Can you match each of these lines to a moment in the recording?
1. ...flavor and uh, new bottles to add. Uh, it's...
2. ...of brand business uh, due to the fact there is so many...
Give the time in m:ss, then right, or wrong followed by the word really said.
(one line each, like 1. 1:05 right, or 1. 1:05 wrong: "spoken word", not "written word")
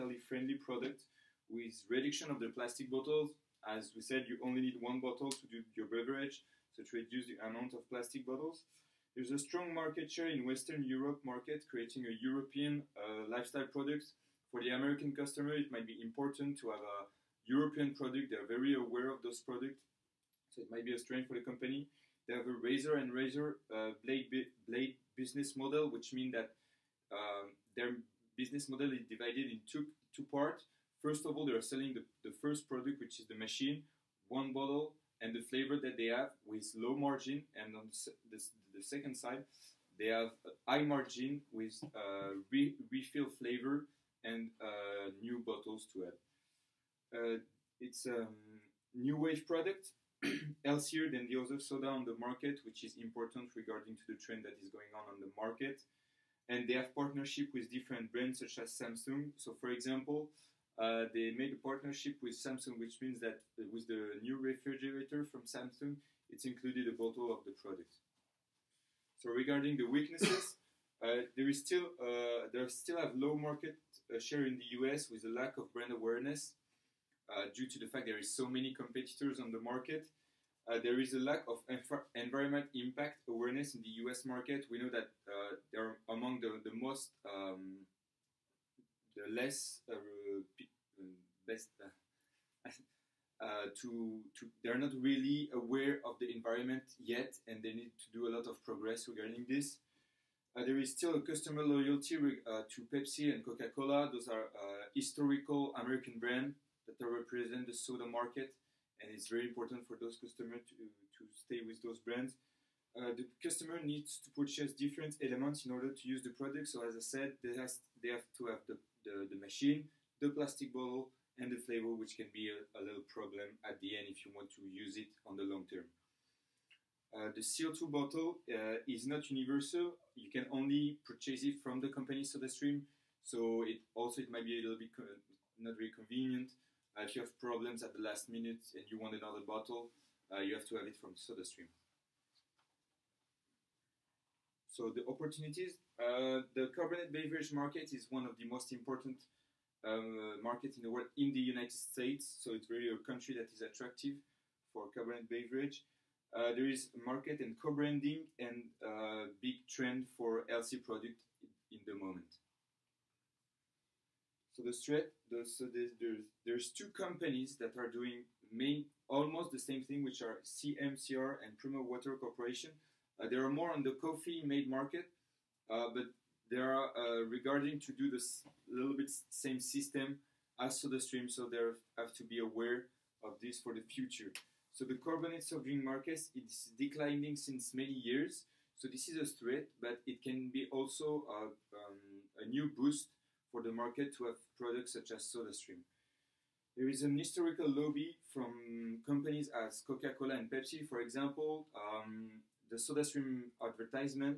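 1. 0:43 right
2. 1:15 wrong: "awareness", not "business".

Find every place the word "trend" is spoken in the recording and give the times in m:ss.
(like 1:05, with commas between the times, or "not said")
0:54, 2:39.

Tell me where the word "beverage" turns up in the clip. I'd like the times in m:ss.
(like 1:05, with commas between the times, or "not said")
0:05, 2:27, 2:35.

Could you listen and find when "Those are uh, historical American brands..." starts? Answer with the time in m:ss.
1:44.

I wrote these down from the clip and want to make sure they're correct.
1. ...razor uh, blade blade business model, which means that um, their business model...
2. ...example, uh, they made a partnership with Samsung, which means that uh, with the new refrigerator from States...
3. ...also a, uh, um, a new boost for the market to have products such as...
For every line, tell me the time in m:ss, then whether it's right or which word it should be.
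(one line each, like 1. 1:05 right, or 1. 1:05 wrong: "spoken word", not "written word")
1. 0:23 right
2. 0:59 wrong: "Samsung", not "States"
3. 3:10 right.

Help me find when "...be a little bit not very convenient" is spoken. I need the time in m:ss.
2:14.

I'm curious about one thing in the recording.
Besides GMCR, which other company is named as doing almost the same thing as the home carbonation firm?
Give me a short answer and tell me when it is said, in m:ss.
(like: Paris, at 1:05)
Primo Water Corporation, at 2:51.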